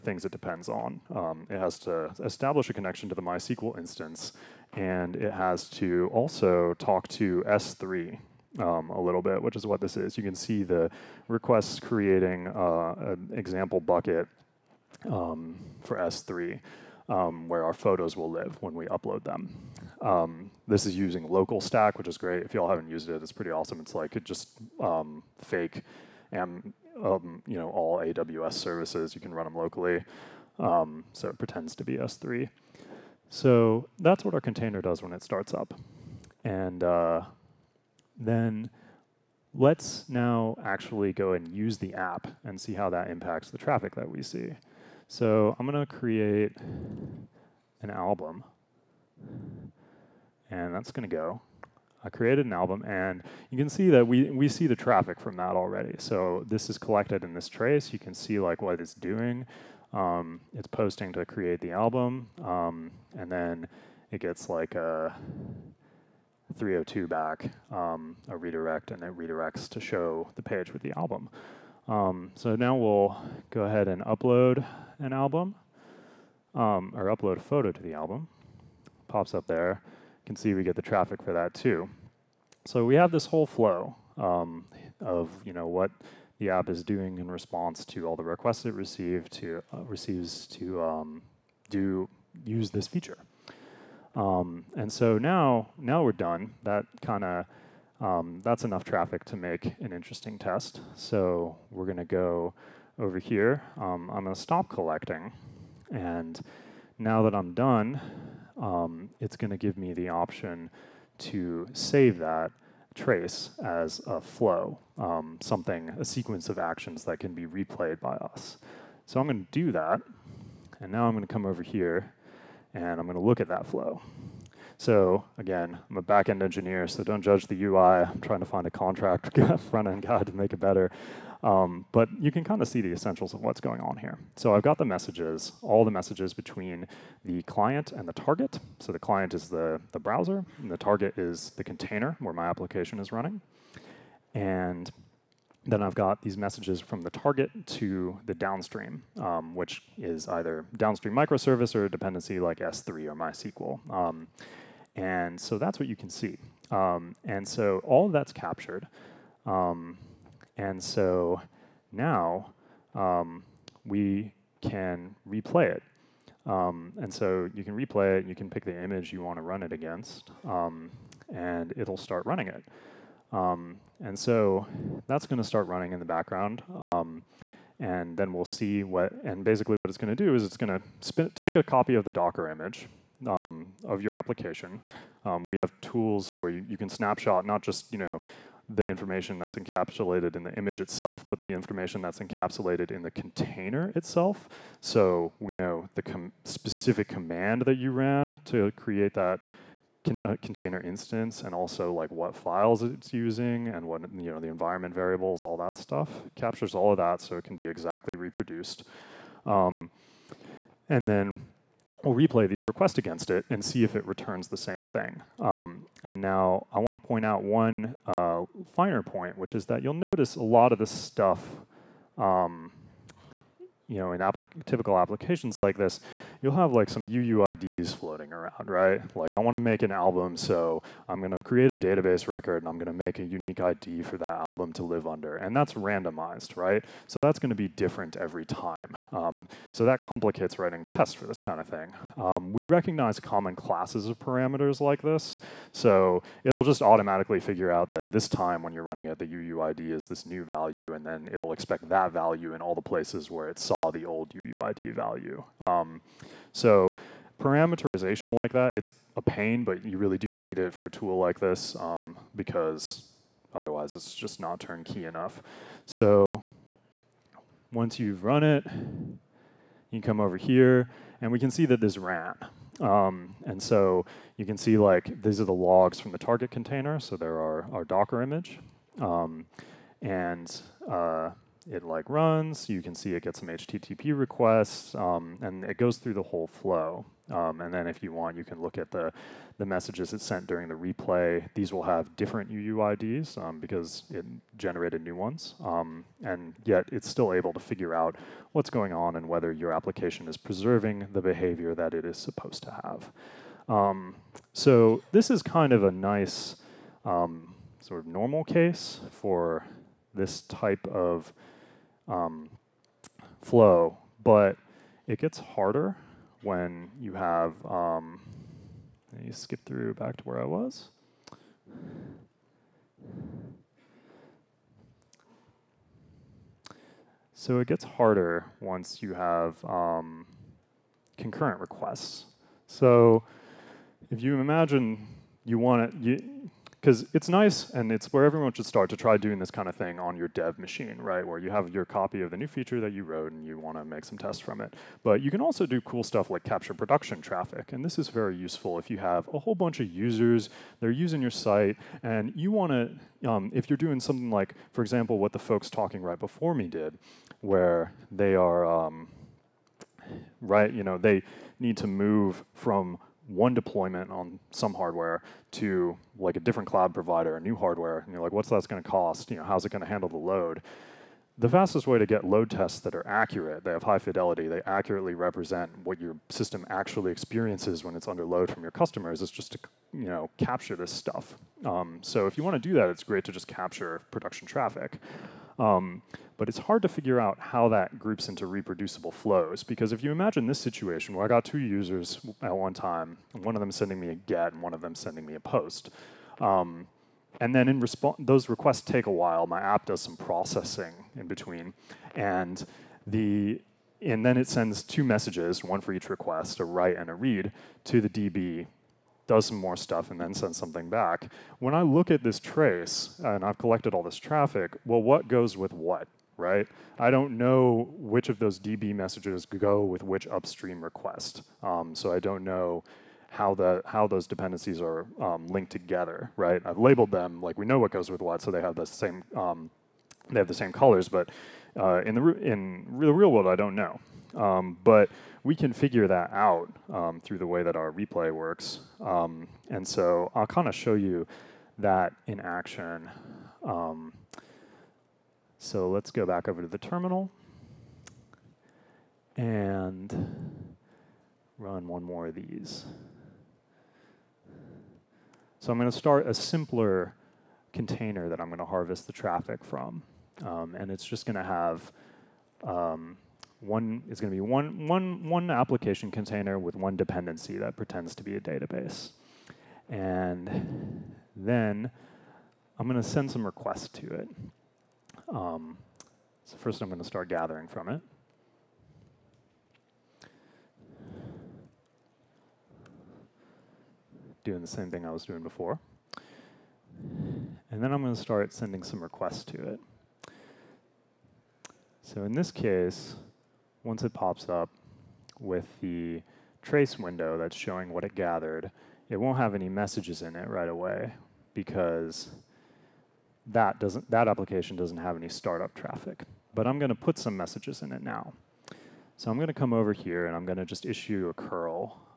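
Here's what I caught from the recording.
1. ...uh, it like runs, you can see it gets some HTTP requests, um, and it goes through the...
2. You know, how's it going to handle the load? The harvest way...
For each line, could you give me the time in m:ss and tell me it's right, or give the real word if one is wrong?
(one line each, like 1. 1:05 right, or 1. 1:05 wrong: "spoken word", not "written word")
1. 4:40 right
2. 6:09 wrong: "fastest", not "harvest".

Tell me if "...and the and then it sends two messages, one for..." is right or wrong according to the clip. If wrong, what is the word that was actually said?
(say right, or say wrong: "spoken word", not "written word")
right.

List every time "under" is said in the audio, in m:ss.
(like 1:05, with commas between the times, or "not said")
3:55, 6:18.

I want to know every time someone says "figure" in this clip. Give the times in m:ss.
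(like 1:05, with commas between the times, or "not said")
4:07, 4:57, 6:26, 7:15.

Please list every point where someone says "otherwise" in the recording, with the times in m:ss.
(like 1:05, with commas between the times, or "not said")
4:23.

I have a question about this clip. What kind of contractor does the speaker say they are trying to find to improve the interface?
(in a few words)
front-end guy.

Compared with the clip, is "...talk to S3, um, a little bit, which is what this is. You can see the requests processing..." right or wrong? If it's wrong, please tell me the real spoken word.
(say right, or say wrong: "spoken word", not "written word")
wrong: "creating", not "processing".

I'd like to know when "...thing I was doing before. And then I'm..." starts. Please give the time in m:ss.
8:04.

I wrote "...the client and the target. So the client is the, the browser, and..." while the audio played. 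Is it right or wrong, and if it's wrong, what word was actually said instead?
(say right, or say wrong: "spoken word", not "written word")
right.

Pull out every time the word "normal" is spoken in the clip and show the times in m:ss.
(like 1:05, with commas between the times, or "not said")
5:08.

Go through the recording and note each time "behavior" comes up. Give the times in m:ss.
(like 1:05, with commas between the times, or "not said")
5:01.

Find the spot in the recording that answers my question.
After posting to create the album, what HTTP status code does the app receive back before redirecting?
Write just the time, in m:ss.
1:06.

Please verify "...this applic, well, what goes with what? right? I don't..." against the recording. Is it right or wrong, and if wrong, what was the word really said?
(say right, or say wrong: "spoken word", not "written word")
wrong: "traffic", not "applic".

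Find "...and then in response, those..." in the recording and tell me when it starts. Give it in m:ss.
6:37.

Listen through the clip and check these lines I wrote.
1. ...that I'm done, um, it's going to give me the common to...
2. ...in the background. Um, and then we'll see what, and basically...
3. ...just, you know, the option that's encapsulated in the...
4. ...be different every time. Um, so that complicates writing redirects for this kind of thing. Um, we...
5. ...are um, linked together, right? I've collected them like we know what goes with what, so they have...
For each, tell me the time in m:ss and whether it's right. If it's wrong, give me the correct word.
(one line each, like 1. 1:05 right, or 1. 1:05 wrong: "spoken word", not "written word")
1. 1:47 wrong: "option", not "common"
2. 2:55 right
3. 3:07 wrong: "information", not "option"
4. 3:57 wrong: "tests", not "redirects"
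5. 7:04 wrong: "labeled", not "collected".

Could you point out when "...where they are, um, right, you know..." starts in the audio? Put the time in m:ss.
5:57.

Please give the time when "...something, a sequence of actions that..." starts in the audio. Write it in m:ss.
1:55.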